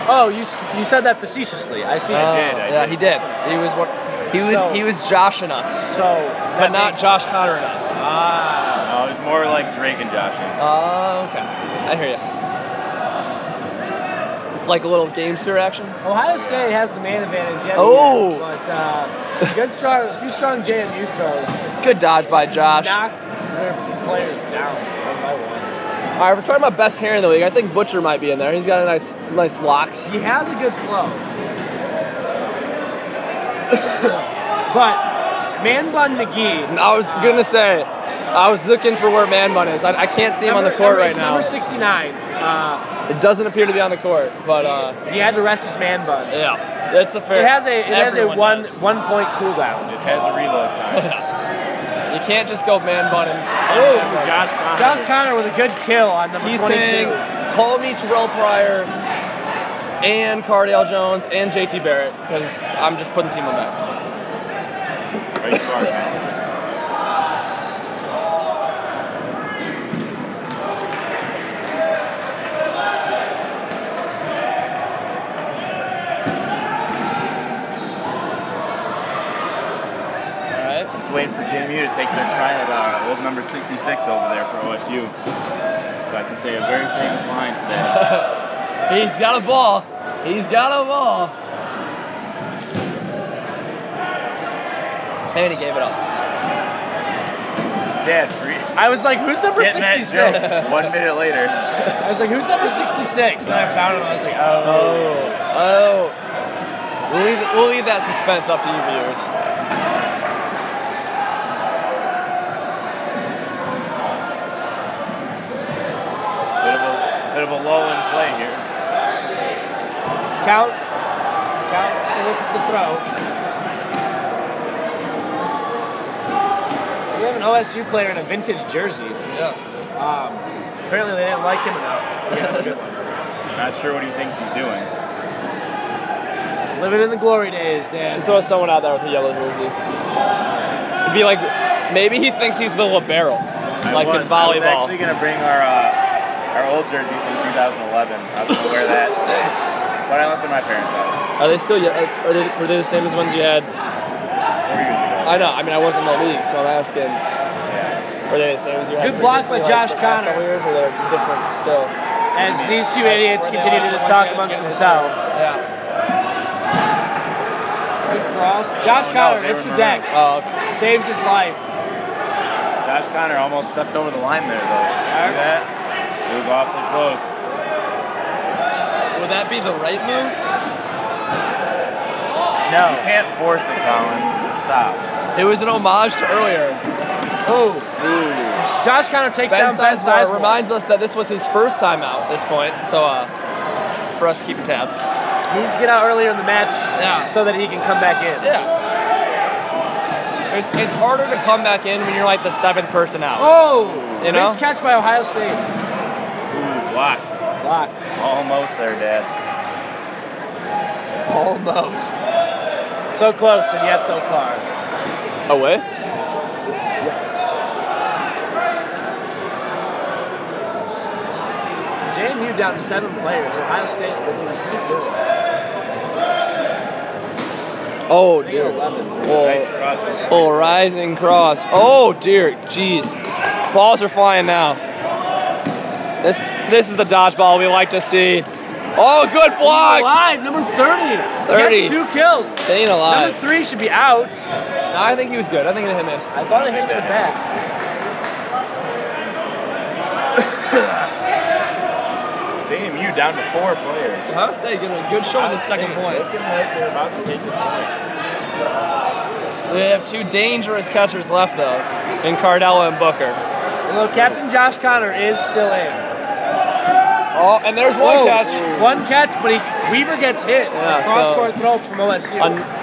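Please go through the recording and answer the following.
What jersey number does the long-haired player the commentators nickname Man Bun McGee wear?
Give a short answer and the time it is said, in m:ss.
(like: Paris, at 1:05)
69, at 0:41.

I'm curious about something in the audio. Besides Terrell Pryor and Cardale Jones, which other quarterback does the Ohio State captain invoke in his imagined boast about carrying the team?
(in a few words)
JT Barrett.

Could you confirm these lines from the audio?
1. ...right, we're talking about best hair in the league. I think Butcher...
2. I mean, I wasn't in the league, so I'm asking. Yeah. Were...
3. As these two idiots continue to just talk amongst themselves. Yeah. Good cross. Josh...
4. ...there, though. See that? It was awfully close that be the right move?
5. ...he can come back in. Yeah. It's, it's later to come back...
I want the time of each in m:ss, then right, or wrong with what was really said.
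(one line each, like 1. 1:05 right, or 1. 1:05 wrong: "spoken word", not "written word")
1. 0:26 right
2. 2:35 right
3. 2:42 right
4. 2:54 right
5. 3:17 wrong: "harder", not "later".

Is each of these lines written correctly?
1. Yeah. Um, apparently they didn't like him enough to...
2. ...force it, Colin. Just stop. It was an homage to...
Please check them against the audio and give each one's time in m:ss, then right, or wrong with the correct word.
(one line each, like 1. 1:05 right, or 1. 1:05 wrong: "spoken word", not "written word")
1. 2:09 right
2. 3:03 right.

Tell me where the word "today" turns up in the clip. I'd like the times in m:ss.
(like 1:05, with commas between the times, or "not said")
1:27, 2:29.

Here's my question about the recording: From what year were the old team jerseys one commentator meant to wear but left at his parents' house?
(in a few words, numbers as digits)
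2011.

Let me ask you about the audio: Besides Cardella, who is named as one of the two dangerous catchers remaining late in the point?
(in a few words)
Booker.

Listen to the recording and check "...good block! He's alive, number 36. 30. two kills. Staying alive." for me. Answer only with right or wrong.
wrong.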